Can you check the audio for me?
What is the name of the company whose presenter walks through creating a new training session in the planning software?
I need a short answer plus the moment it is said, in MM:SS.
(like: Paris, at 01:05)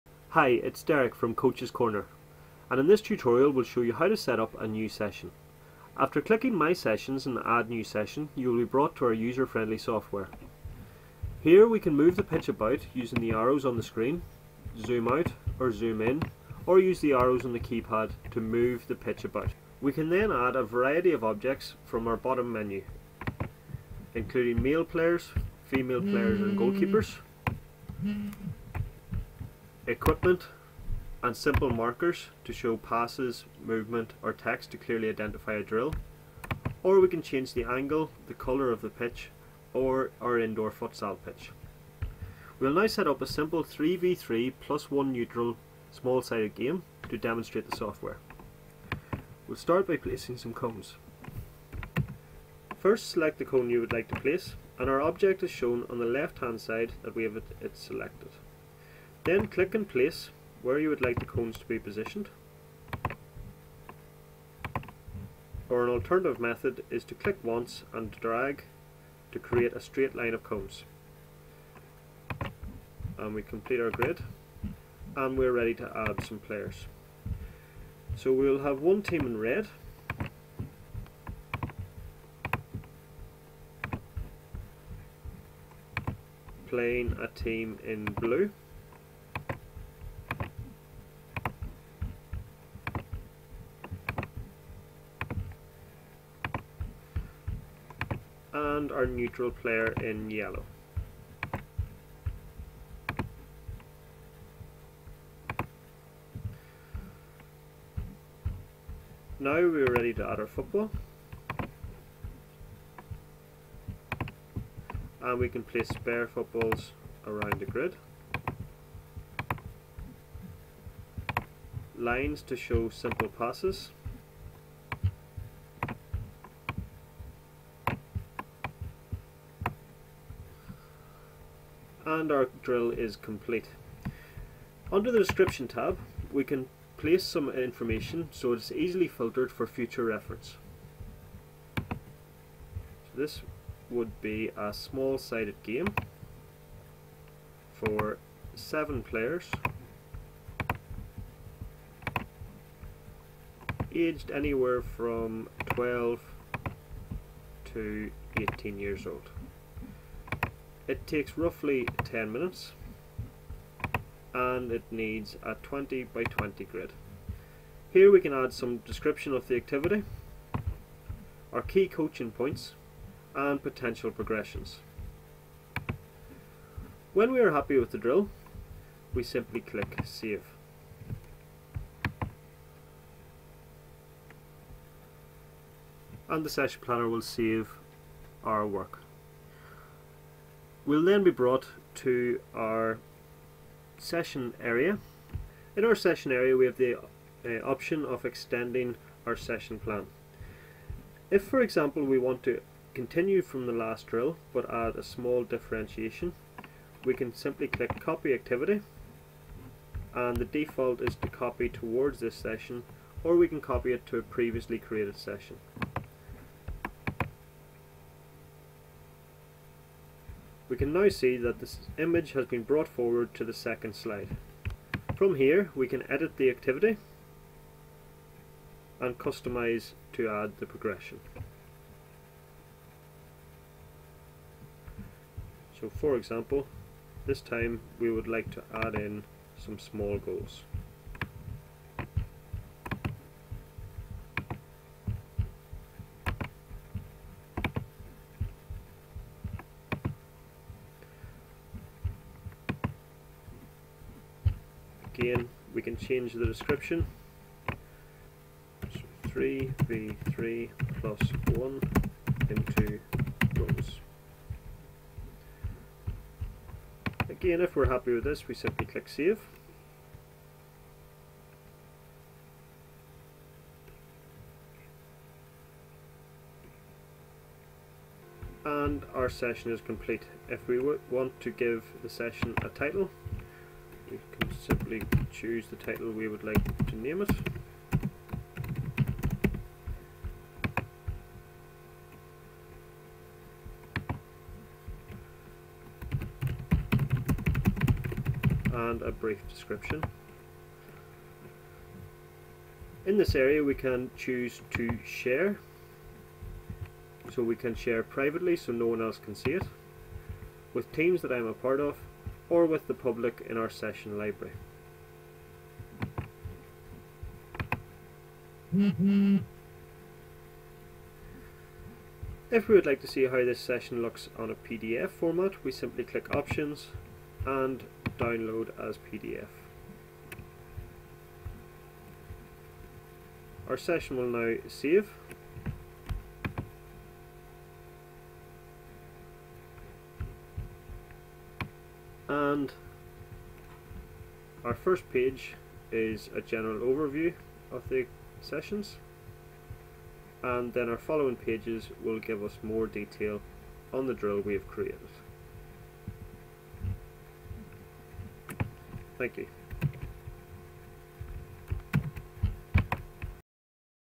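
Coaches Corner, at 00:01.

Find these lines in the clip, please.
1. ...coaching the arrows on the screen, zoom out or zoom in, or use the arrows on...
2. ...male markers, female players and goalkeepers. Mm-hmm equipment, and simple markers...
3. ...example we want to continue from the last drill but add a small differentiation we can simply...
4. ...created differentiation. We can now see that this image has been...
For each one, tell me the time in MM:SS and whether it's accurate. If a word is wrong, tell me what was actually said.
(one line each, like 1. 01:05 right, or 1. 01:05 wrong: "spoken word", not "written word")
1. 00:12 wrong: "using", not "coaching"
2. 00:24 wrong: "players", not "markers"
3. 03:21 right
4. 03:34 wrong: "session", not "differentiation".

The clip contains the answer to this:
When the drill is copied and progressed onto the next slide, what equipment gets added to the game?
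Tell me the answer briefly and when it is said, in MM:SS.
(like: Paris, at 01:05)
small goals, at 03:59.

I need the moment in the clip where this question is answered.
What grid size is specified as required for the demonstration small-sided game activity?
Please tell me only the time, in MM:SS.
02:45.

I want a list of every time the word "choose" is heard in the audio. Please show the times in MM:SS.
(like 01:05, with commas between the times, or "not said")
04:45, 05:04.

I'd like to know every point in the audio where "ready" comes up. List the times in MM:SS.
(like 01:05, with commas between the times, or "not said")
01:15, 01:49.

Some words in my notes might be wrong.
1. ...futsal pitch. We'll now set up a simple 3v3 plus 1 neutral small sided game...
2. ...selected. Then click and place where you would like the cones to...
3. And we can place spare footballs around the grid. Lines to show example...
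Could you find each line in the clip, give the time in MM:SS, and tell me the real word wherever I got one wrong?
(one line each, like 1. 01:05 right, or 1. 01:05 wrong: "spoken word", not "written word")
1. 00:40 right
2. 00:57 right
3. 01:55 wrong: "simple", not "example".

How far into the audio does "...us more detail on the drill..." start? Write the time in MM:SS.
05:52.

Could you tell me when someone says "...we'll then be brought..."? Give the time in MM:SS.
03:10.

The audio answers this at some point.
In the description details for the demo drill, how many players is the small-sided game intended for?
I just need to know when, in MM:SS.
02:28.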